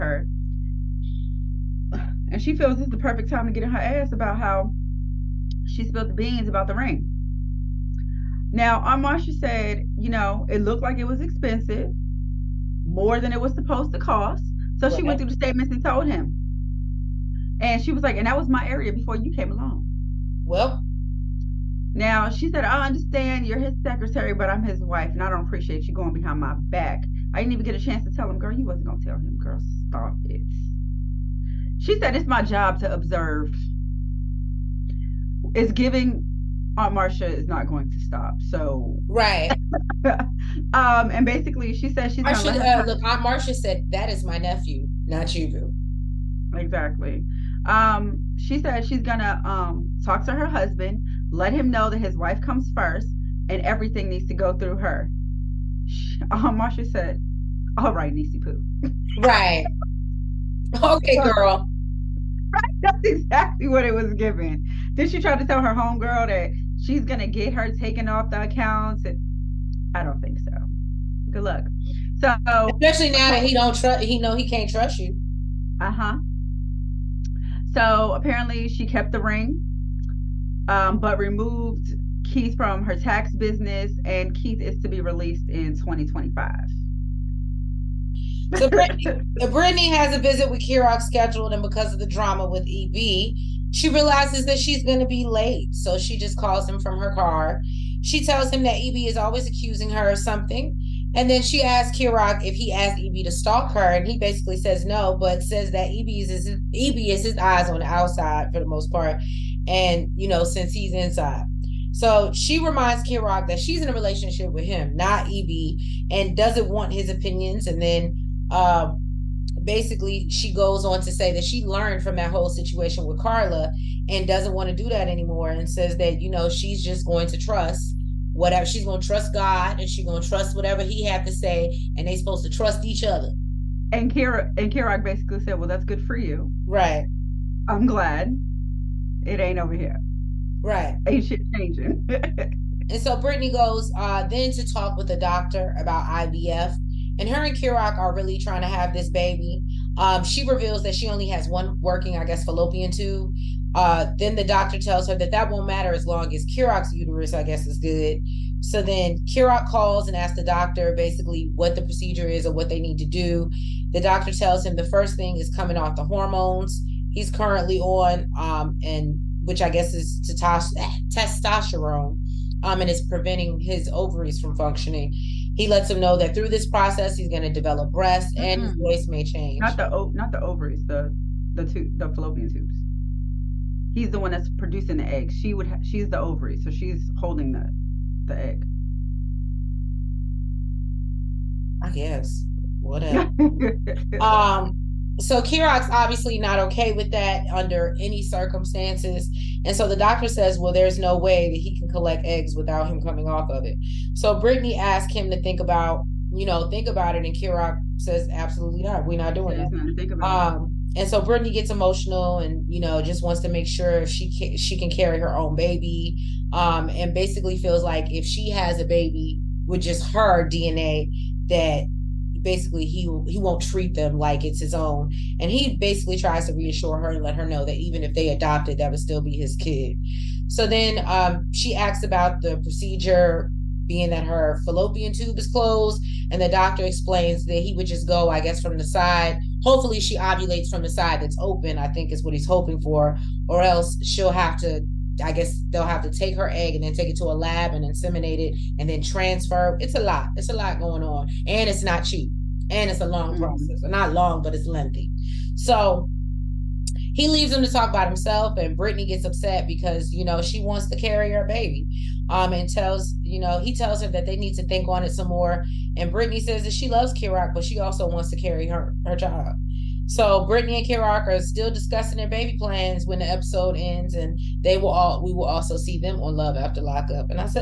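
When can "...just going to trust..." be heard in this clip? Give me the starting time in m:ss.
2:06.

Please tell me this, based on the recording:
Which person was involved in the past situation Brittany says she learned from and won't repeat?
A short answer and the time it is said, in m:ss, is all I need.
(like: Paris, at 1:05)
Carla, at 2:03.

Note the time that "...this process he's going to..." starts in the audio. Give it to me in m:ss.
2:56.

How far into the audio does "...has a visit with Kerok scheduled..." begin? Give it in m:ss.
1:29.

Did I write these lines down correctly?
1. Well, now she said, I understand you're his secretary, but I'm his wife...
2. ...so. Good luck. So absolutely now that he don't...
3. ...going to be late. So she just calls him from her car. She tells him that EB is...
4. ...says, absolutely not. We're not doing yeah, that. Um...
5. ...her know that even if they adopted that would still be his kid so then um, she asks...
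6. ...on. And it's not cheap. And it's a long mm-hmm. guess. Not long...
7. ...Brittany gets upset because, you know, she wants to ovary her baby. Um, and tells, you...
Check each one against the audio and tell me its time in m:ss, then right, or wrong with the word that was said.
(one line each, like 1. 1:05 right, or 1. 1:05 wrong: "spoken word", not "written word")
1. 0:20 right
2. 1:10 wrong: "especially", not "absolutely"
3. 1:34 right
4. 3:27 right
5. 3:47 right
6. 4:11 wrong: "process", not "guess"
7. 4:18 wrong: "carry", not "ovary".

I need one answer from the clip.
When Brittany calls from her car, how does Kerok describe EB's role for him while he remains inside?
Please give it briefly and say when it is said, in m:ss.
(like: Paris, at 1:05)
Eyes on the outside, at 1:47.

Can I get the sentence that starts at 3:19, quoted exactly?
And so the doctor says, well, there's no way that he can collect eggs without him coming off of it.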